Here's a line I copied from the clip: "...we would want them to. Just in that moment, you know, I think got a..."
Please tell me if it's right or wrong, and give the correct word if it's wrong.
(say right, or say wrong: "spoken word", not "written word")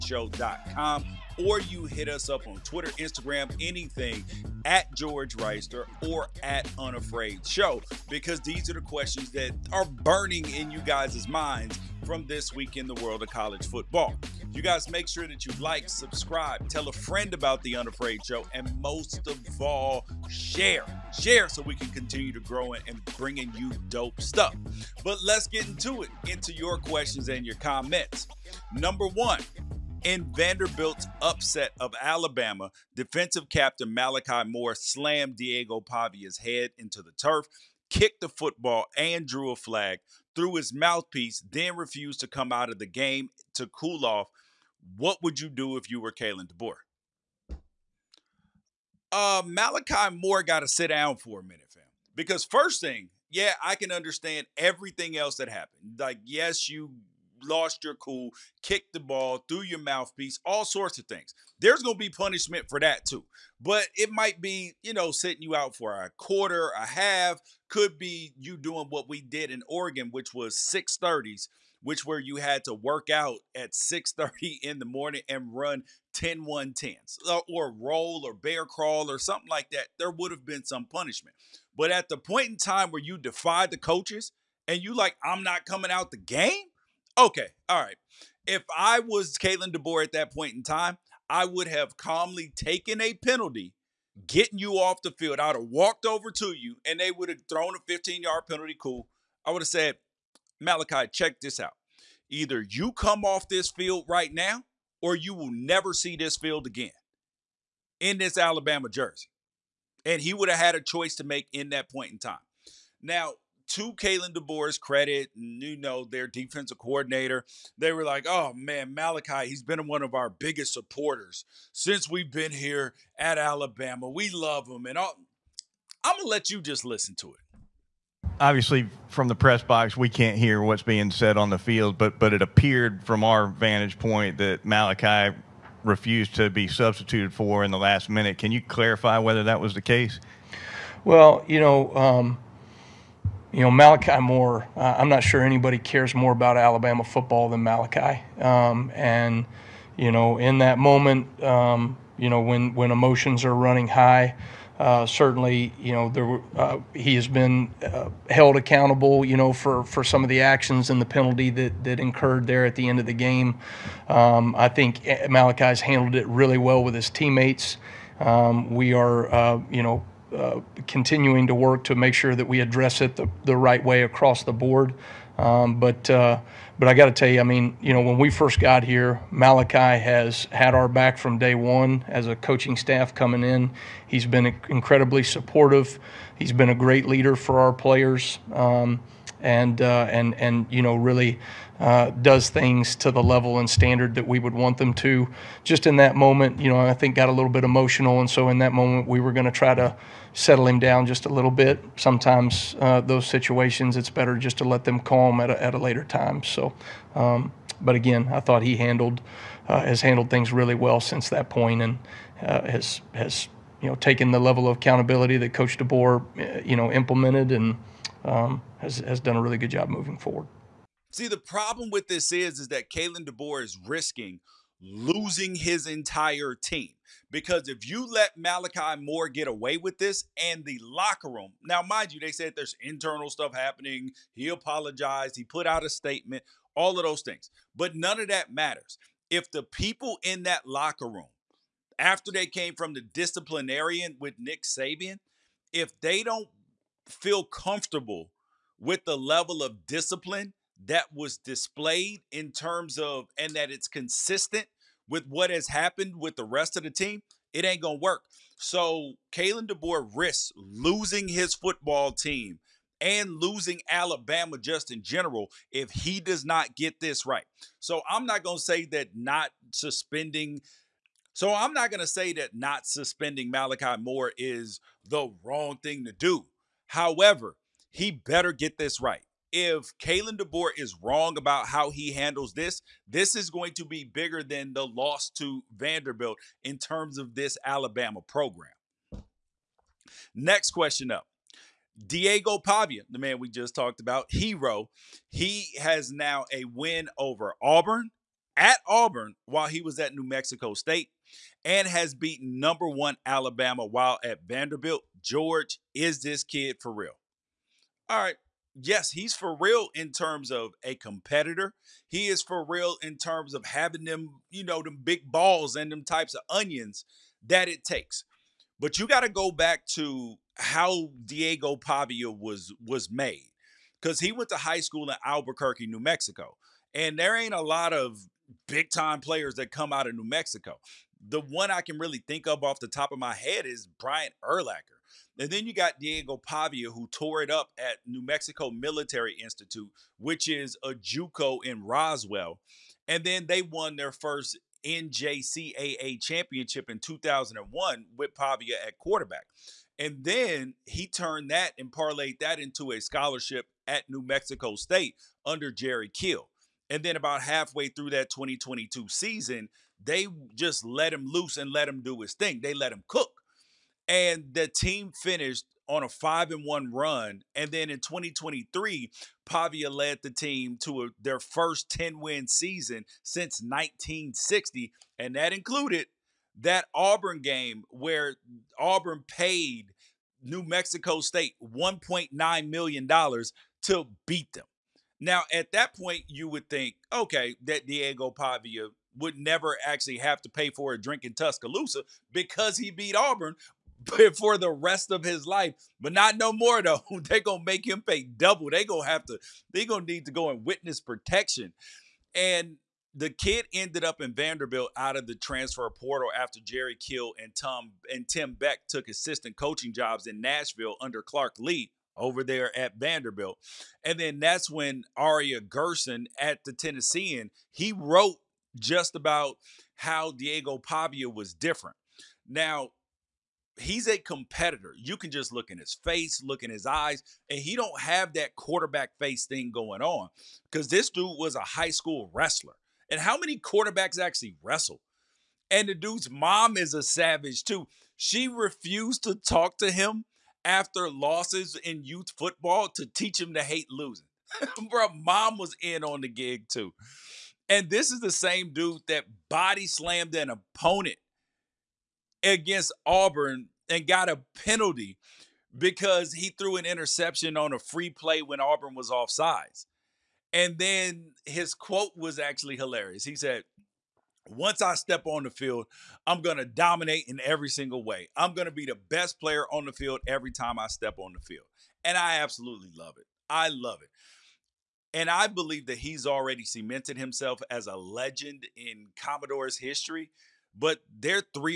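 right.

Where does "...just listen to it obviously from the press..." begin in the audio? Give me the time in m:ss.
2:06.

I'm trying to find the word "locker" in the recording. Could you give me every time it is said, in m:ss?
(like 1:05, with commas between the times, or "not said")
3:50, 4:00.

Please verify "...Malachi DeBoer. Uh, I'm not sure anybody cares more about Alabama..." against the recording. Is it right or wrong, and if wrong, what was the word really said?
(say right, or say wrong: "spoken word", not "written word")
wrong: "Moore", not "DeBoer".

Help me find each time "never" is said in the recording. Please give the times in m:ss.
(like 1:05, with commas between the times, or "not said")
1:45, 6:29.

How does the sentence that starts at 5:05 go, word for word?
George, is this kid for real?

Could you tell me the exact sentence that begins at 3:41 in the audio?
See, the problem with this is, is that Kalen DeBoer is risking losing his entire team.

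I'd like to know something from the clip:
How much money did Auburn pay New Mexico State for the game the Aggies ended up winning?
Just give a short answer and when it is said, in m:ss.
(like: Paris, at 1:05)
$1.9 million, at 6:21.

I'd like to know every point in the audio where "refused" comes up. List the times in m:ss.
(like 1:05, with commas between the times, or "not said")
0:41, 2:15, 7:18.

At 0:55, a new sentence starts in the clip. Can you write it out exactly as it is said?
Like, yes, you lost your cool, kicked the ball threw your mouthpiece, all sorts of things.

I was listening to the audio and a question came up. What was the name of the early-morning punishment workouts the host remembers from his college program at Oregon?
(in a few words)
630s.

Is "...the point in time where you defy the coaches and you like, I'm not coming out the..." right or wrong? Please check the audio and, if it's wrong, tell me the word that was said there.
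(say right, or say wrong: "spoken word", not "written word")
right.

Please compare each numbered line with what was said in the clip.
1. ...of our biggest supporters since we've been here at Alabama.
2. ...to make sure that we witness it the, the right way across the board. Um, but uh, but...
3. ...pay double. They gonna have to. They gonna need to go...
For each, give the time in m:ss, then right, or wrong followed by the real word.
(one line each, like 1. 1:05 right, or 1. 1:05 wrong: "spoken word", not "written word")
1. 2:00 right
2. 2:51 wrong: "address", not "witness"
3. 6:38 right.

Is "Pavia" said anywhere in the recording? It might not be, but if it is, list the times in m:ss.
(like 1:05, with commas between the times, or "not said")
0:35, 4:52, 5:21, 5:36, 5:48, 6:09, 6:28, 7:00.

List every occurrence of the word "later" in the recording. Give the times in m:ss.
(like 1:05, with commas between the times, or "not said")
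3:25.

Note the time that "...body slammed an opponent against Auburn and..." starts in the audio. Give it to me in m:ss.
7:29.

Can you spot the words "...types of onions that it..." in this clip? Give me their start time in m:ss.
5:16.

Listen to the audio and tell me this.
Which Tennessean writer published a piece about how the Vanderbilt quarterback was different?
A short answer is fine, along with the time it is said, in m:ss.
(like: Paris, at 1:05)
Aria Gerson, at 6:55.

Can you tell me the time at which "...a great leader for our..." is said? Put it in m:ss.
3:06.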